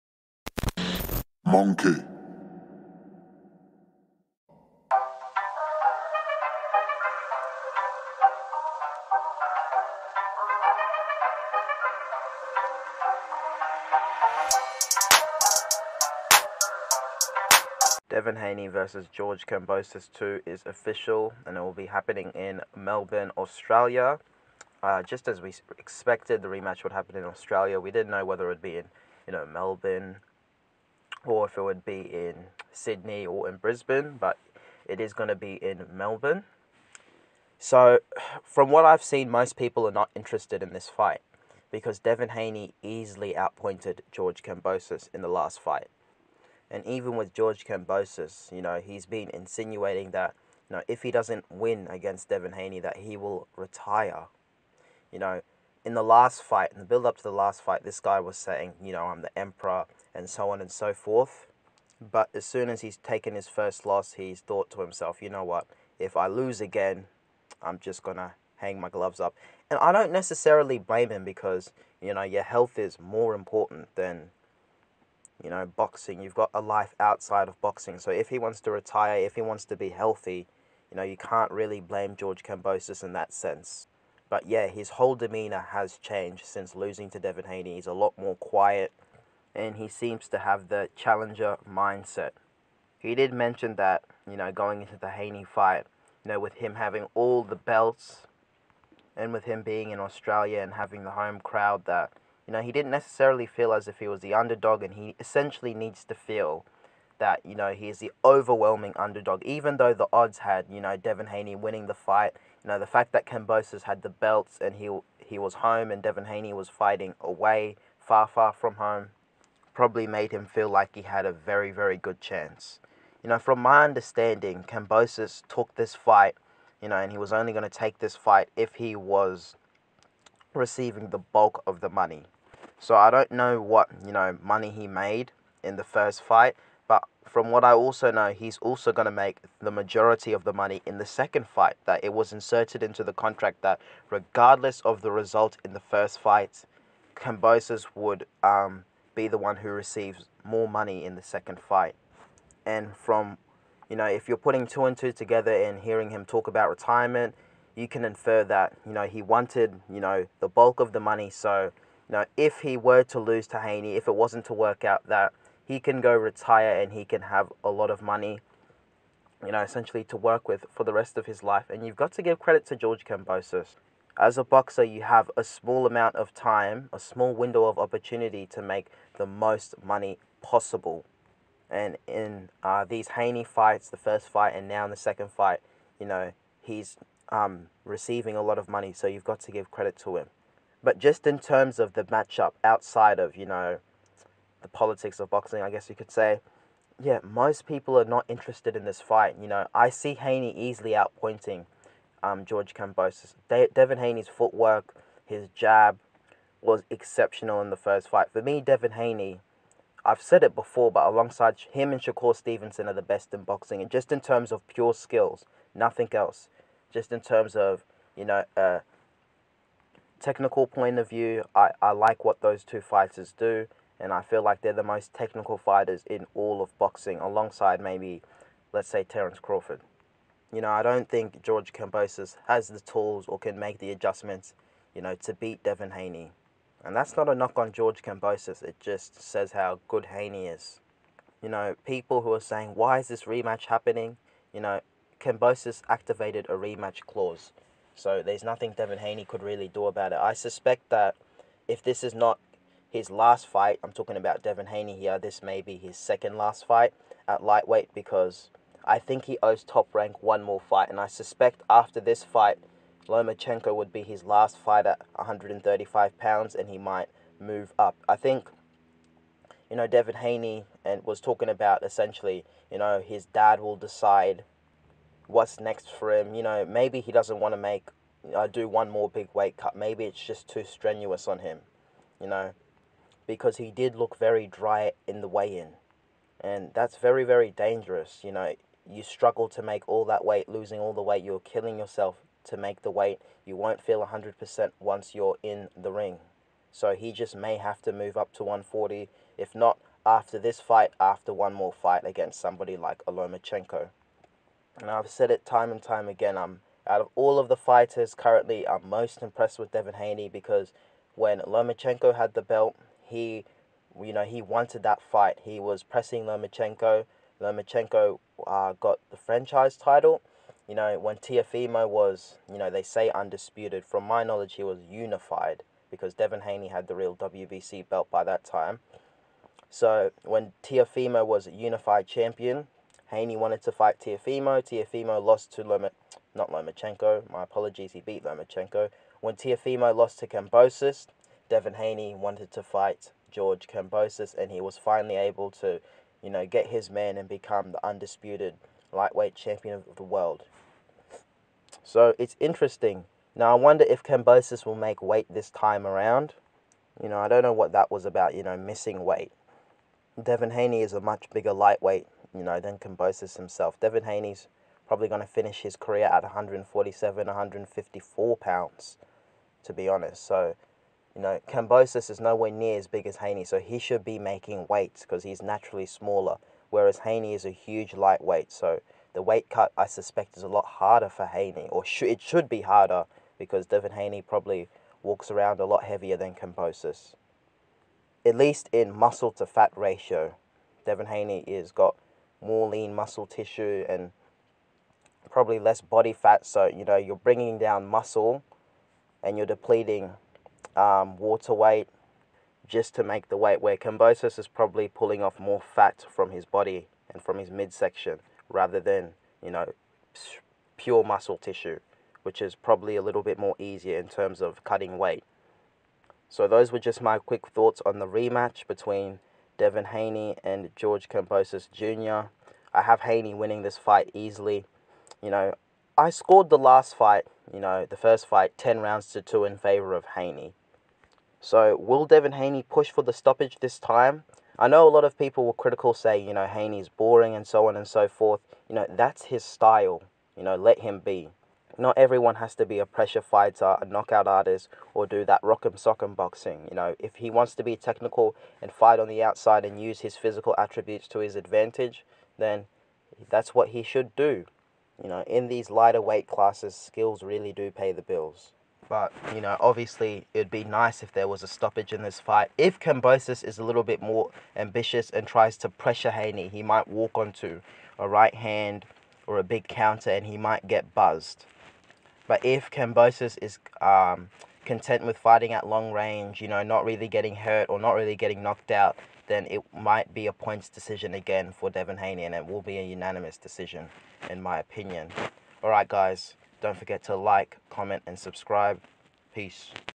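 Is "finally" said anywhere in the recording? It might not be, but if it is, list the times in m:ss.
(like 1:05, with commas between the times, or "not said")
5:44.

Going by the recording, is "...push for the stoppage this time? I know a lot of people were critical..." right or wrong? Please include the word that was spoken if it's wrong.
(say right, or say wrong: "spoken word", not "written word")
right.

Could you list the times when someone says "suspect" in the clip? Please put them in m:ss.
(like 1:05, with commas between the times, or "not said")
4:10, 4:21, 6:19.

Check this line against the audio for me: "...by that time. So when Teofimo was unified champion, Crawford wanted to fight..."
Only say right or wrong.
wrong.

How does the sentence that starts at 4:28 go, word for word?
I think, you know, David Haney and was talking about essentially, you know, his dad will decide what's next for him.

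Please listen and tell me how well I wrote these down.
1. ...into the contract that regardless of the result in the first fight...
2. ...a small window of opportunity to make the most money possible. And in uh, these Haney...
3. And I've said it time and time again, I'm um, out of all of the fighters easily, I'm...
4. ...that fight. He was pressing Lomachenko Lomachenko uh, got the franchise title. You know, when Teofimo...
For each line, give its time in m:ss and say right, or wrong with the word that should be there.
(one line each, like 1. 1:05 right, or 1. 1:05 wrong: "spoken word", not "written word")
1. 2:22 right
2. 2:56 right
3. 5:04 wrong: "currently", not "easily"
4. 5:14 right.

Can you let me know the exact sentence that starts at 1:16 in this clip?
You've got a life outside of boxing.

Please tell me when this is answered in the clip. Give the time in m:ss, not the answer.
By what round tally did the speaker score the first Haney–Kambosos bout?
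7:08.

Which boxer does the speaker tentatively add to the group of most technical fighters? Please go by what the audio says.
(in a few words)
Terence Crawford.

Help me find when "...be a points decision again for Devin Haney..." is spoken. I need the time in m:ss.
8:00.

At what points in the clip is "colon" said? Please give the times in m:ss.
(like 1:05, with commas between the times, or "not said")
not said.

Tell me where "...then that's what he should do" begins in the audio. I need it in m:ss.
7:32.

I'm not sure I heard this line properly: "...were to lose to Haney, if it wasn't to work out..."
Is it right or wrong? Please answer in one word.
right.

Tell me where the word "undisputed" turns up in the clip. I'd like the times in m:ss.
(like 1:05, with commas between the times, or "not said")
5:23, 5:47.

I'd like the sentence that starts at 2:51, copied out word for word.
And you've got to give credit to George Kambosos.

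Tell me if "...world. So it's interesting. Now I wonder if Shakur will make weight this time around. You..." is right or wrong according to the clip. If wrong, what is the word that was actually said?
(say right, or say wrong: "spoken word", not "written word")
wrong: "Kambosos", not "Shakur".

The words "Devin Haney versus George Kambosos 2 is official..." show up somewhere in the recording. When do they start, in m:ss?
0:18.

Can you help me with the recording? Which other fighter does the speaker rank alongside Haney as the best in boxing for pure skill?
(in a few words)
Shakur Stevenson.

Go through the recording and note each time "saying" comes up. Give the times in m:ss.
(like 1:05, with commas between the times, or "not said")
0:58, 4:02.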